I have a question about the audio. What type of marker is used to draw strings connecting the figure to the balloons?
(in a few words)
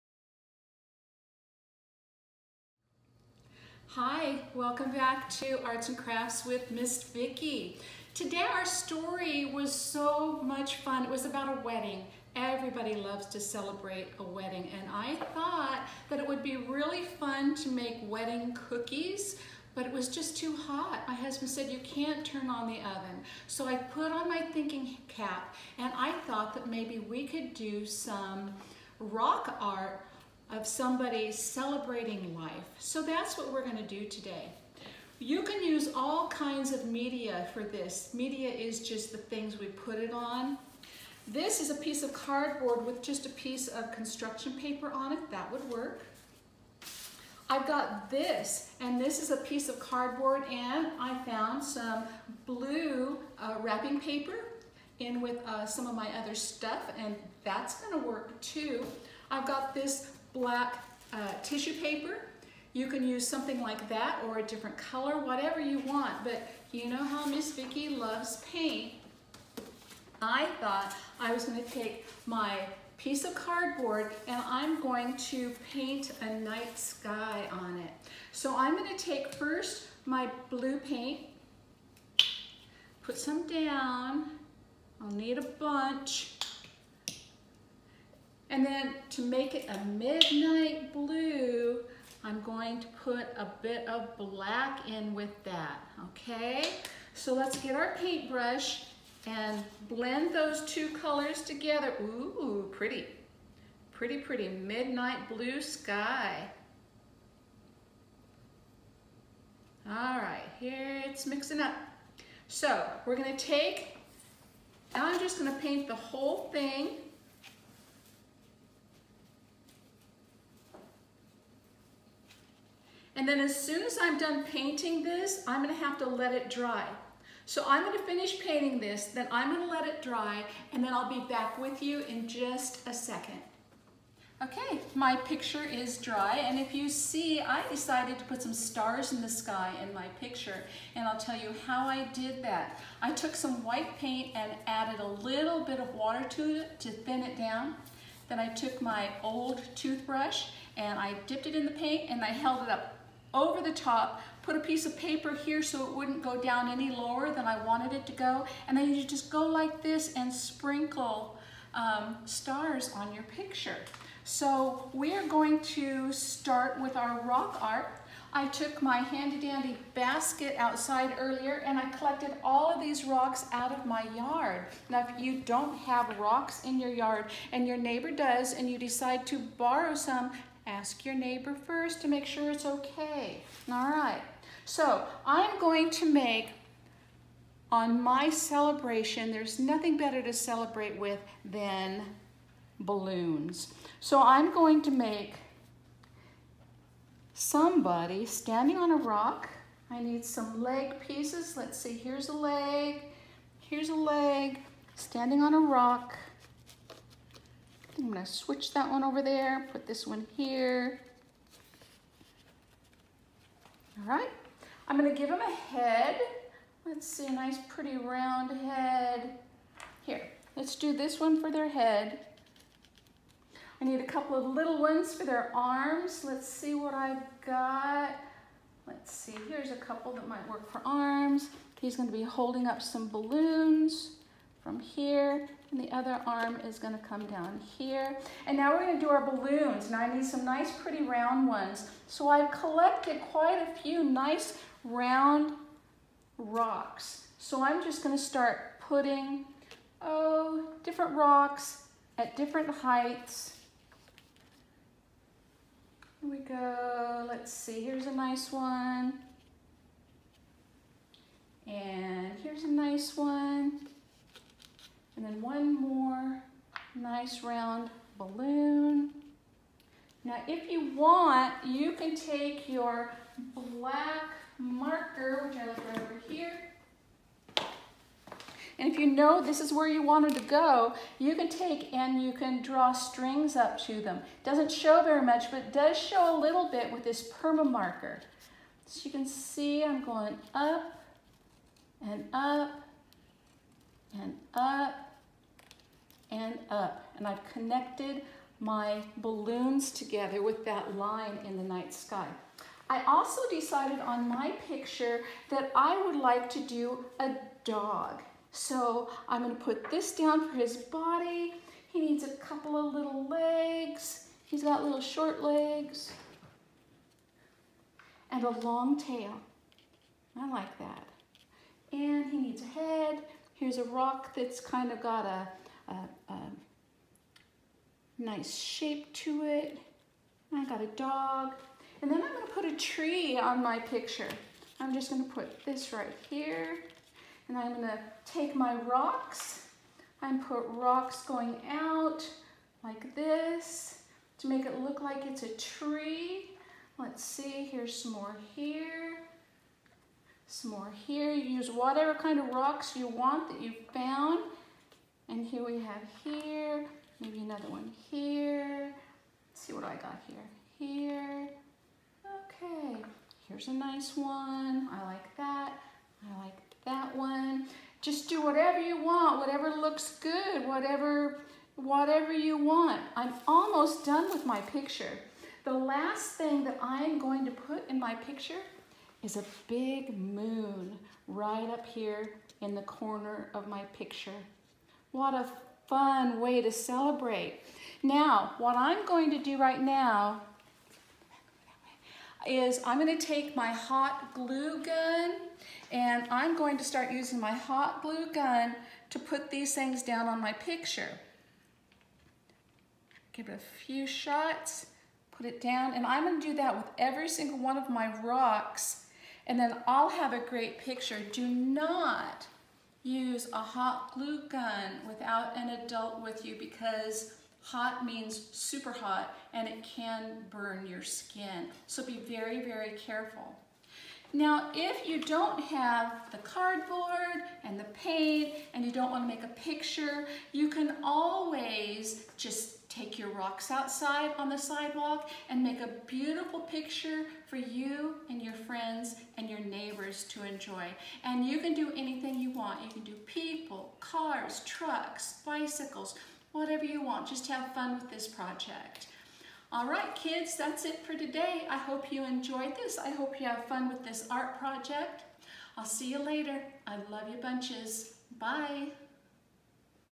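black marker.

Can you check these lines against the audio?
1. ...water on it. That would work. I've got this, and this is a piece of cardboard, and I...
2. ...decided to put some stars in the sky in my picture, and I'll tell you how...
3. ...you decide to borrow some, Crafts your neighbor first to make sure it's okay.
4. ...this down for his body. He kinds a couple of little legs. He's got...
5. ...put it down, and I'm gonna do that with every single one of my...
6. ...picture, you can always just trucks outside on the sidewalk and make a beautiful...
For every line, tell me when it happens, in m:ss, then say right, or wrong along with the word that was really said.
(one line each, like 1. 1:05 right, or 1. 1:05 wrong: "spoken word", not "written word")
1. 0:44 wrong: "paper", not "water"
2. 2:17 right
3. 2:58 wrong: "Ask", not "Crafts"
4. 5:09 wrong: "needs", not "kinds"
5. 6:45 right
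6. 7:09 wrong: "rocks", not "trucks".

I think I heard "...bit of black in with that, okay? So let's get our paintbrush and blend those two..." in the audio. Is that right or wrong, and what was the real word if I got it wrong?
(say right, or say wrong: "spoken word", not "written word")
right.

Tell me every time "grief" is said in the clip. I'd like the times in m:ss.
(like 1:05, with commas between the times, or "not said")
not said.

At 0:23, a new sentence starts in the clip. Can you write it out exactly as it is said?
So I put on my thinking cap and I thought that maybe we could do some rock art of somebody celebrating life.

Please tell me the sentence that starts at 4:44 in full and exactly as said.
It doesn't show very much, but it does show a little bit with this perma marker.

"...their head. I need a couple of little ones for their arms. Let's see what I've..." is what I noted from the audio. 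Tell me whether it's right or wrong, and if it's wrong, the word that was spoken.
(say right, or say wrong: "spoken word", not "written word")
right.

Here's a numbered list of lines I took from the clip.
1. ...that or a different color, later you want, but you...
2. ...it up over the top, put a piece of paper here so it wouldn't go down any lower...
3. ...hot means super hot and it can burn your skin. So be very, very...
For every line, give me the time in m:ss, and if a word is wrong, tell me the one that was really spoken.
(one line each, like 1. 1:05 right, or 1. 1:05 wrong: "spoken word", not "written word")
1. 1:03 wrong: "whatever", not "later"
2. 2:32 right
3. 6:57 right.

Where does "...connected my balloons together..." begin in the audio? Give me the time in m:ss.
4:57.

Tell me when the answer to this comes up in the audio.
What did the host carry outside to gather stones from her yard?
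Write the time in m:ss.
2:49.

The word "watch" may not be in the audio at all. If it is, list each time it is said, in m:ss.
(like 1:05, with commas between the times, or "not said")
not said.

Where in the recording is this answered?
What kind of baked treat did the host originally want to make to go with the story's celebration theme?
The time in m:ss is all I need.
0:18.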